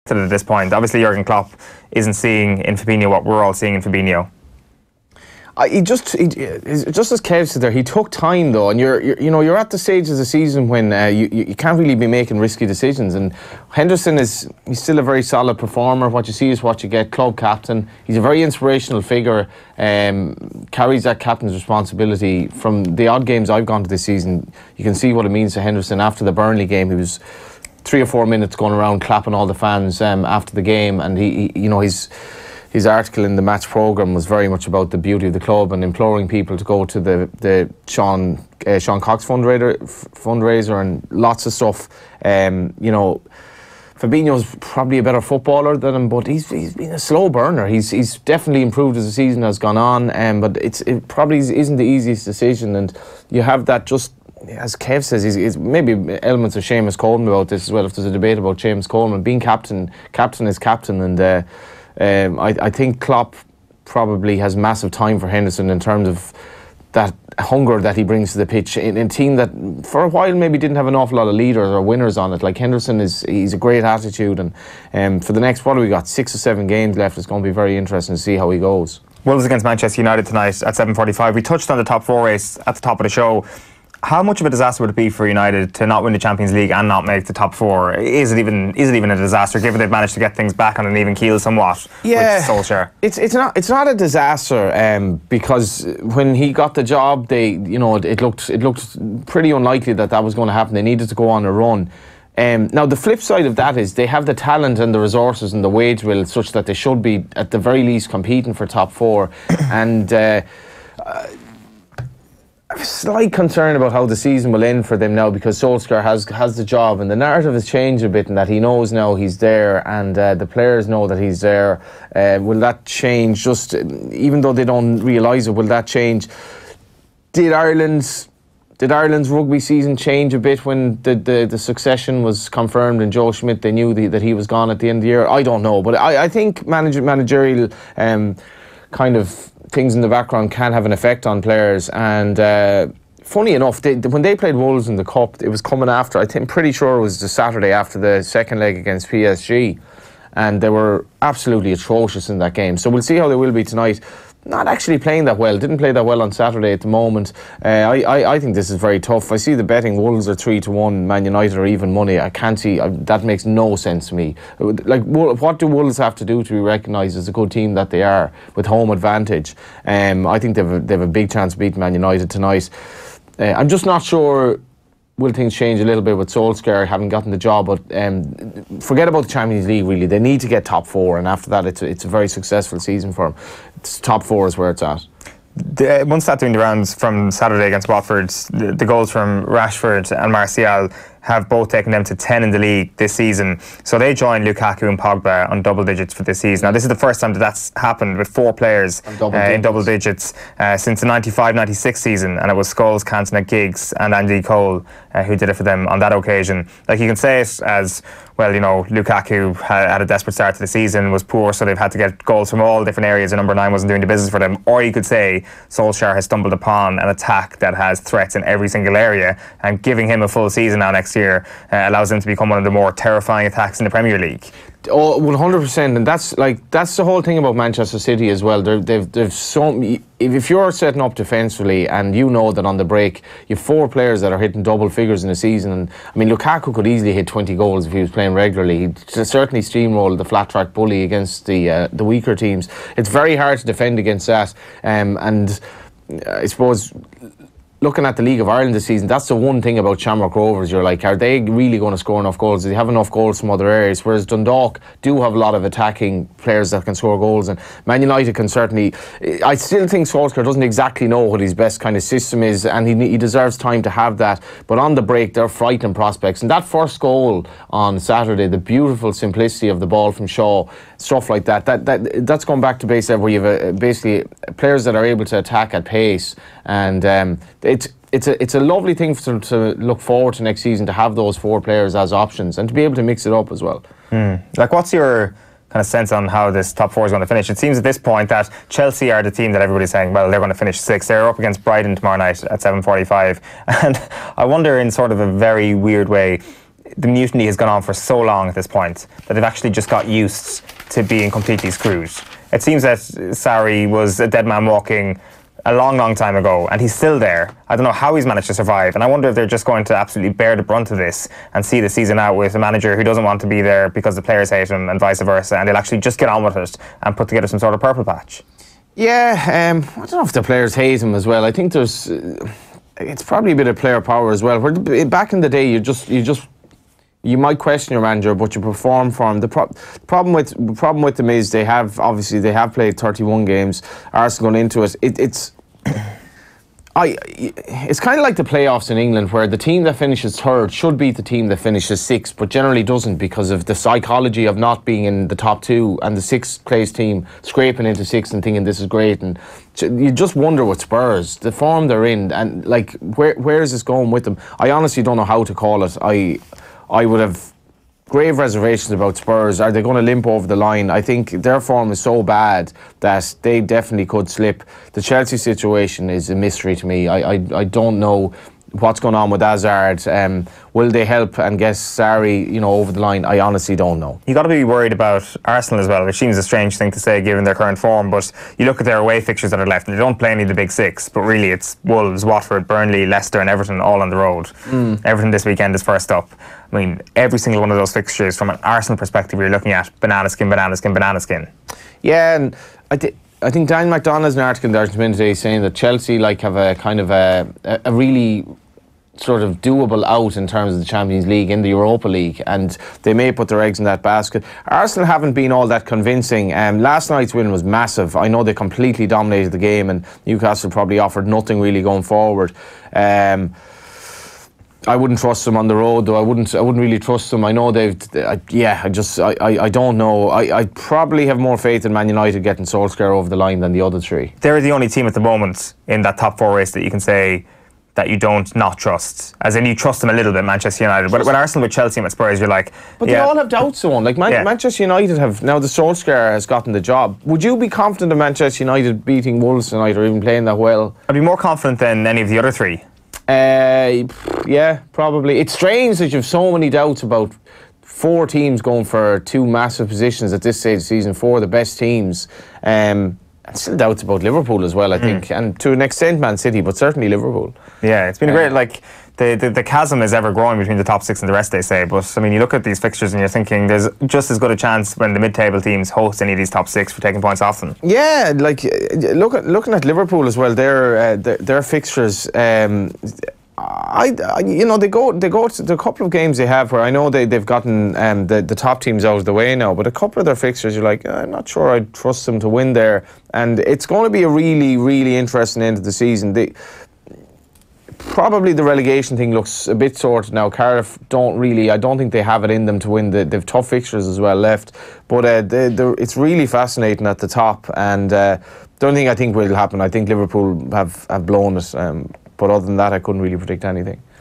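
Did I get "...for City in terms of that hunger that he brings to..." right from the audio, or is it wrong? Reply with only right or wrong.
wrong.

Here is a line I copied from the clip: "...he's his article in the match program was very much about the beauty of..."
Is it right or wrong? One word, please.
right.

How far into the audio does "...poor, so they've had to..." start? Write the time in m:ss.
3:31.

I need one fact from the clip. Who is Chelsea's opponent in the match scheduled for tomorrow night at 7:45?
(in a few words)
Brighton.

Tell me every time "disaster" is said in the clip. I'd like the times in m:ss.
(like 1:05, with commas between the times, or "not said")
1:24, 1:29, 1:33.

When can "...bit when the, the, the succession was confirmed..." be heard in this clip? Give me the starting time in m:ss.
2:10.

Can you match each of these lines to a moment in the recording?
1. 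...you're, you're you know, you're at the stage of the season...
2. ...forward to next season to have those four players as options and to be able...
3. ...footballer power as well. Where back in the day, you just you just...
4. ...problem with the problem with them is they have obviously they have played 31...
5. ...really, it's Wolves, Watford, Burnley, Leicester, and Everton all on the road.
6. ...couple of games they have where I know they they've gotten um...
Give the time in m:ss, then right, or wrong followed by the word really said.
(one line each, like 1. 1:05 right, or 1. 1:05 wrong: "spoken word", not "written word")
1. 0:08 right
2. 4:40 right
3. 5:23 wrong: "player", not "footballer"
4. 5:30 right
5. 6:21 right
6. 7:55 right.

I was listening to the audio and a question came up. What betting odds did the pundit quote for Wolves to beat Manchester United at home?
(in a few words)
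3 to 1.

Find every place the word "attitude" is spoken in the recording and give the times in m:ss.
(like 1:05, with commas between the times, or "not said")
1:13.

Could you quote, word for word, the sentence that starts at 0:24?
You can see what it means to Henderson after the Burnley game.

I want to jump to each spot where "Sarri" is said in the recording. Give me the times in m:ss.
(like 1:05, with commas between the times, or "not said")
5:02, 6:11.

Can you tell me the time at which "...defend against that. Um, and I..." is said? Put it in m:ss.
4:03.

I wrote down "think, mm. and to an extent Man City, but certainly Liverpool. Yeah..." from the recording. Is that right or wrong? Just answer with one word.
right.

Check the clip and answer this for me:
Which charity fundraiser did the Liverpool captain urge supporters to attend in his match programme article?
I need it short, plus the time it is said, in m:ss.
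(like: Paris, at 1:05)
Sean Cox fundraiser, at 0:38.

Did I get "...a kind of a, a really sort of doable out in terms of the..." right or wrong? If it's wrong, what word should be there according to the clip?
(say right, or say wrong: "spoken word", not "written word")
right.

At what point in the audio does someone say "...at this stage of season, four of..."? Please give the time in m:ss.
7:30.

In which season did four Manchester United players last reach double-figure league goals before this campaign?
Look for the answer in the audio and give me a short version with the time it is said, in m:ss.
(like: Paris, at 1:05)
1995-96, at 3:21.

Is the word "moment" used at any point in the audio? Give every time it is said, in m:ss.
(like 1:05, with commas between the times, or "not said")
2:36, 7:05.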